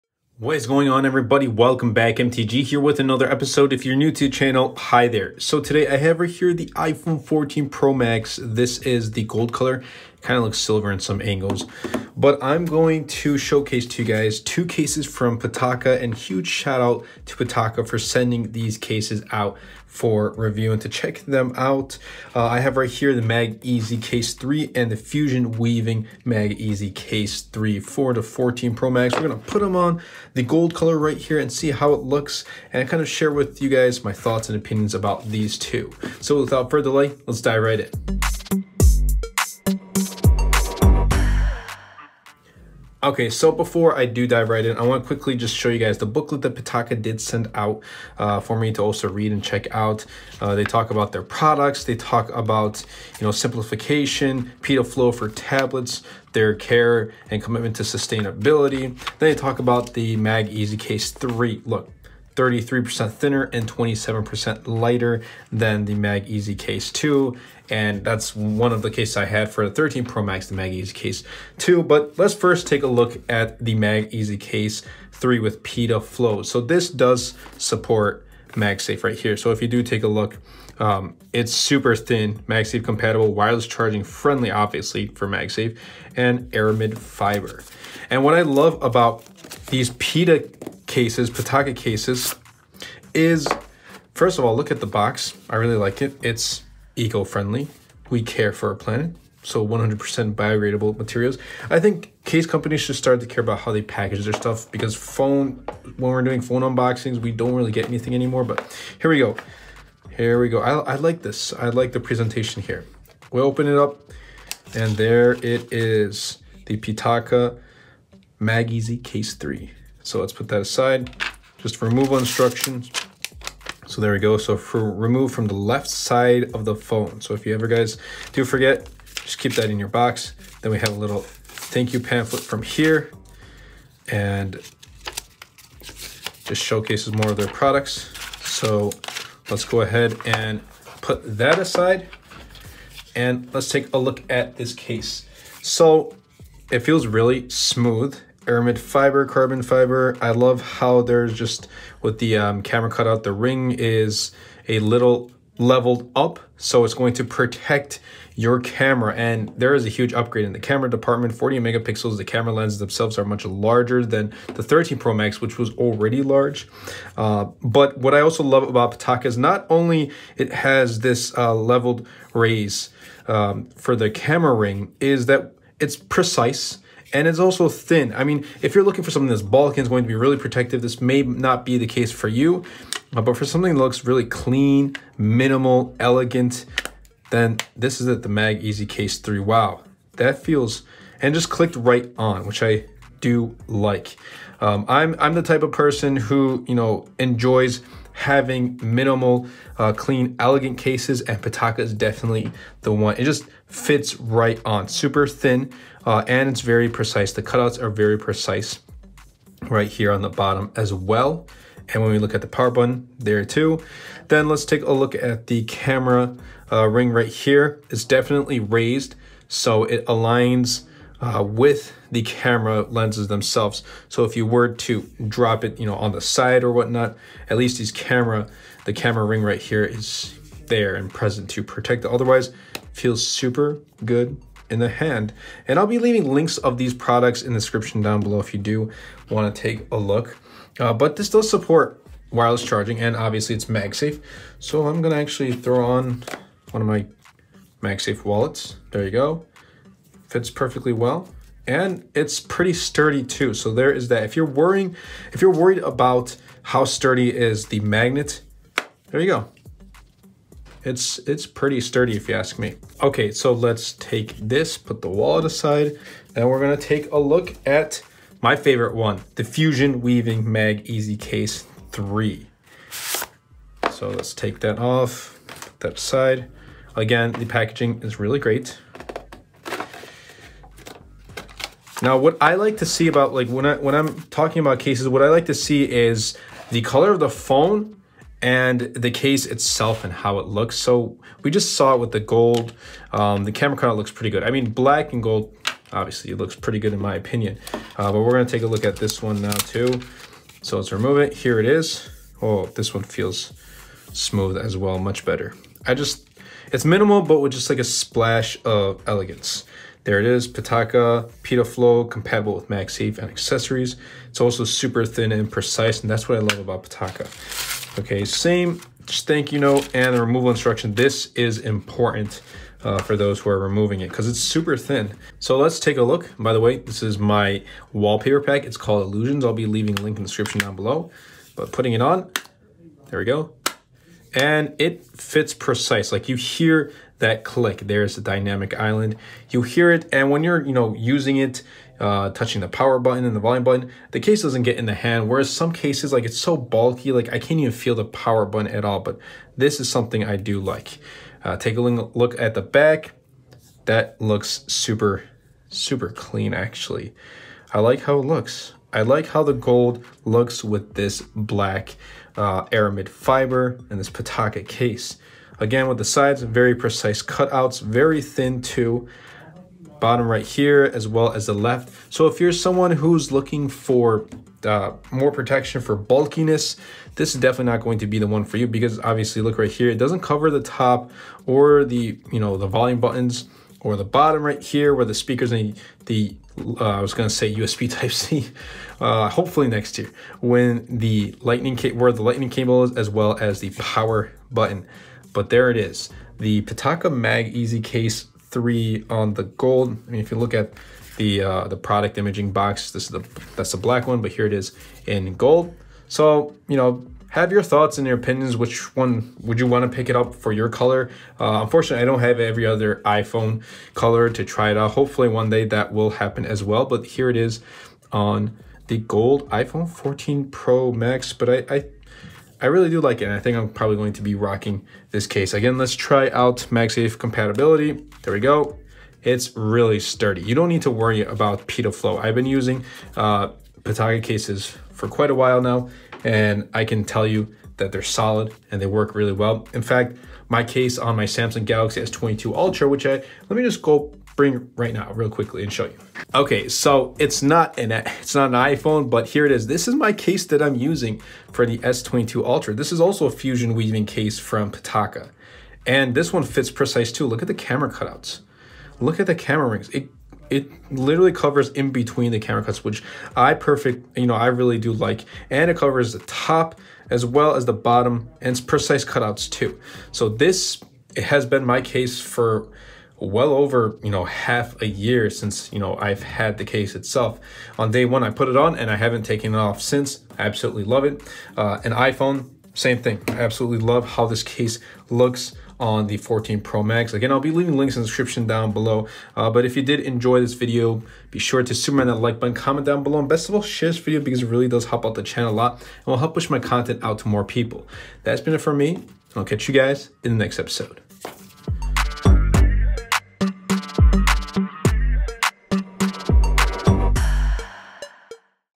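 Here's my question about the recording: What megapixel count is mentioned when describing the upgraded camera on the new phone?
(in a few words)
40 megapixels.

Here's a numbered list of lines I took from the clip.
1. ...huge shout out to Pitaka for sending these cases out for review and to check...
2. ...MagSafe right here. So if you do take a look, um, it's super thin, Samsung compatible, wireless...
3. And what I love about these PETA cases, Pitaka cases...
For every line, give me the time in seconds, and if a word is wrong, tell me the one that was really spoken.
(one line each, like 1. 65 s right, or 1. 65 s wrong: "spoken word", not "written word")
1. 16 s right
2. 78 s wrong: "MagSafe", not "Samsung"
3. 88 s right.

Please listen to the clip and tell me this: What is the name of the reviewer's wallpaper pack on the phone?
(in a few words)
Illusions.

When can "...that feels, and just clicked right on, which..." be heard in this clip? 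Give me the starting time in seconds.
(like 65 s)
190 s.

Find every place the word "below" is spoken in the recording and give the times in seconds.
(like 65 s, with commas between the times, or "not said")
238 s, 330 s, 488 s, 493 s.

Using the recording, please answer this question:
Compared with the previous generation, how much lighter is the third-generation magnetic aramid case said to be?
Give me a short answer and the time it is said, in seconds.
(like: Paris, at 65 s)
27%, at 63 s.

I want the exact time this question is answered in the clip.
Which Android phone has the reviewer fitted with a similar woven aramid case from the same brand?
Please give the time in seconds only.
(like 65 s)
441 s.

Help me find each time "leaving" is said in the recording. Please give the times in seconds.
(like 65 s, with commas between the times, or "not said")
235 s, 329 s, 487 s.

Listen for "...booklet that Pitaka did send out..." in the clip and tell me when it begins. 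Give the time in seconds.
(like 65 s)
46 s.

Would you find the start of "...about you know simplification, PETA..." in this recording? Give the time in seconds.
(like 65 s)
52 s.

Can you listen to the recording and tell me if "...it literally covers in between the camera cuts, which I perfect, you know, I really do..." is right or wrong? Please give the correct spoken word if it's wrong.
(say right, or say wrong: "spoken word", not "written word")
right.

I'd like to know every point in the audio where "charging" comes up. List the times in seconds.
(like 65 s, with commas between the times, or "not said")
83 s, 242 s.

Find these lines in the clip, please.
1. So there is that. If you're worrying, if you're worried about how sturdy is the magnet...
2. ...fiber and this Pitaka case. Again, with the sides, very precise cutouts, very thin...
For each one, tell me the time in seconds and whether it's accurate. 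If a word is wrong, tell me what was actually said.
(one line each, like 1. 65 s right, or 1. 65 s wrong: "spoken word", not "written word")
1. 253 s right
2. 363 s right.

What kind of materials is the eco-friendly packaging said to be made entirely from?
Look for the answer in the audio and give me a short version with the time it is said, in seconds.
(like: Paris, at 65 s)
biodegradable materials, at 99 s.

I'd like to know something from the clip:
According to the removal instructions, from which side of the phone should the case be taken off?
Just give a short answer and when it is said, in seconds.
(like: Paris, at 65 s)
left side, at 125 s.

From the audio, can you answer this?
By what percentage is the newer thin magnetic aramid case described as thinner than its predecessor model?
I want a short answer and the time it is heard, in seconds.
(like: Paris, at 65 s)
33%, at 62 s.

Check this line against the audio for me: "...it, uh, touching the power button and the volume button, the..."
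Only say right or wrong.
right.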